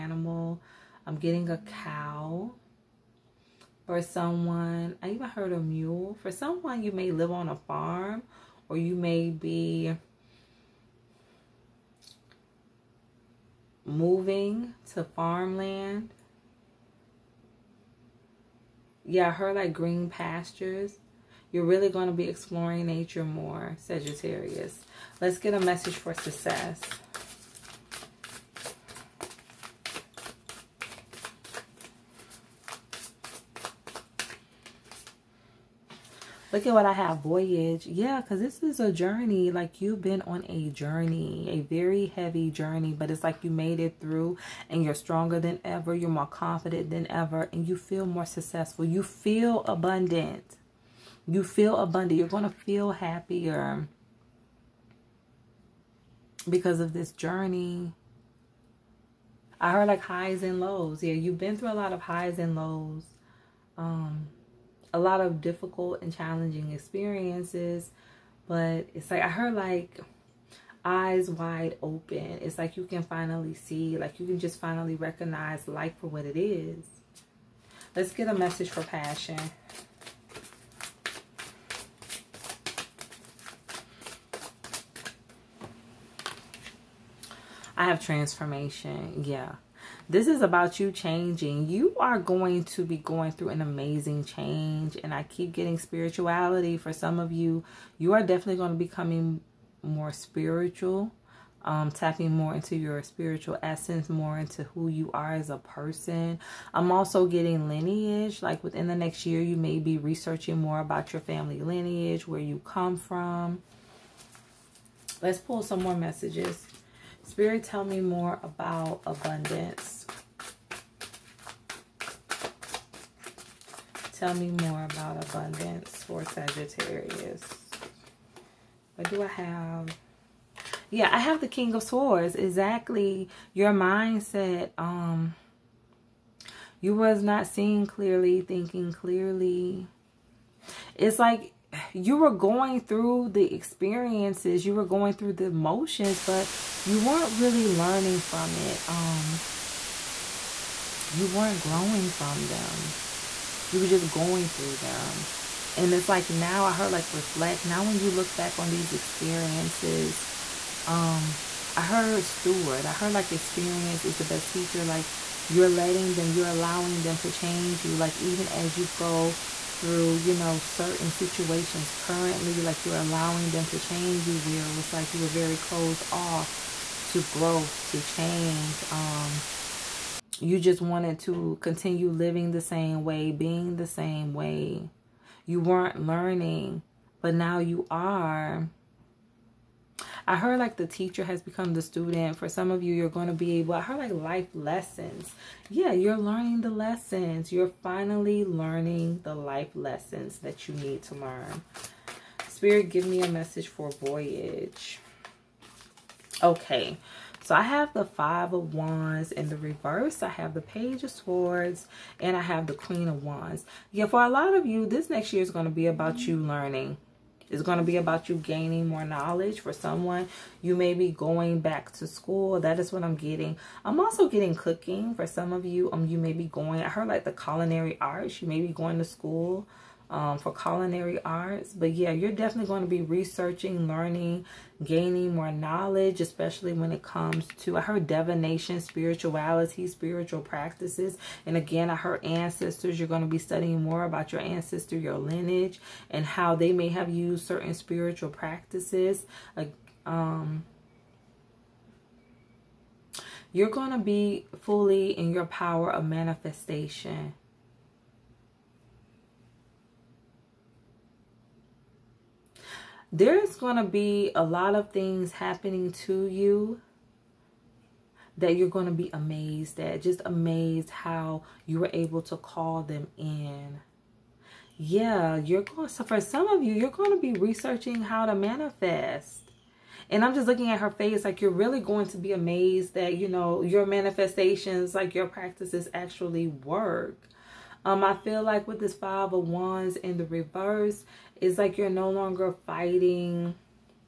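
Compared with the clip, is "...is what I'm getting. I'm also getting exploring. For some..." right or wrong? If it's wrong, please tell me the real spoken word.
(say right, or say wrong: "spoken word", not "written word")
wrong: "cooking", not "exploring".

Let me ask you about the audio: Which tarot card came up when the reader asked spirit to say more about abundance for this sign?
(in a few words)
King of Swords.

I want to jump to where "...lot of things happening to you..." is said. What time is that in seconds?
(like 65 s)
264 s.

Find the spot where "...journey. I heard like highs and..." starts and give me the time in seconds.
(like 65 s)
57 s.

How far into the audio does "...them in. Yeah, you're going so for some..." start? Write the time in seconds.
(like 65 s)
272 s.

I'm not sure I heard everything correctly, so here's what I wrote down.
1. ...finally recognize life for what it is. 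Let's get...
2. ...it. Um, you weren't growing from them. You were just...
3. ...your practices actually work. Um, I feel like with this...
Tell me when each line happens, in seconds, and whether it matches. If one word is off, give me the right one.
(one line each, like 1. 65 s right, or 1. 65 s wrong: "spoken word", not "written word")
1. 74 s right
2. 148 s right
3. 285 s right.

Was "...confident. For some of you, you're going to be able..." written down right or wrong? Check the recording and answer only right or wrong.
wrong.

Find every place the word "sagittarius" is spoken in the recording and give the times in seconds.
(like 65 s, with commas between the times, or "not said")
23 s, 126 s.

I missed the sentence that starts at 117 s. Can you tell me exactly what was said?
Spirit, tell me more about abundance.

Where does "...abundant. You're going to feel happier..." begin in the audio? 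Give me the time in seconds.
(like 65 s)
51 s.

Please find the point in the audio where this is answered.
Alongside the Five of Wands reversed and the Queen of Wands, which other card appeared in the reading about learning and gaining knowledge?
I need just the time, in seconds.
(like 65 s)
210 s.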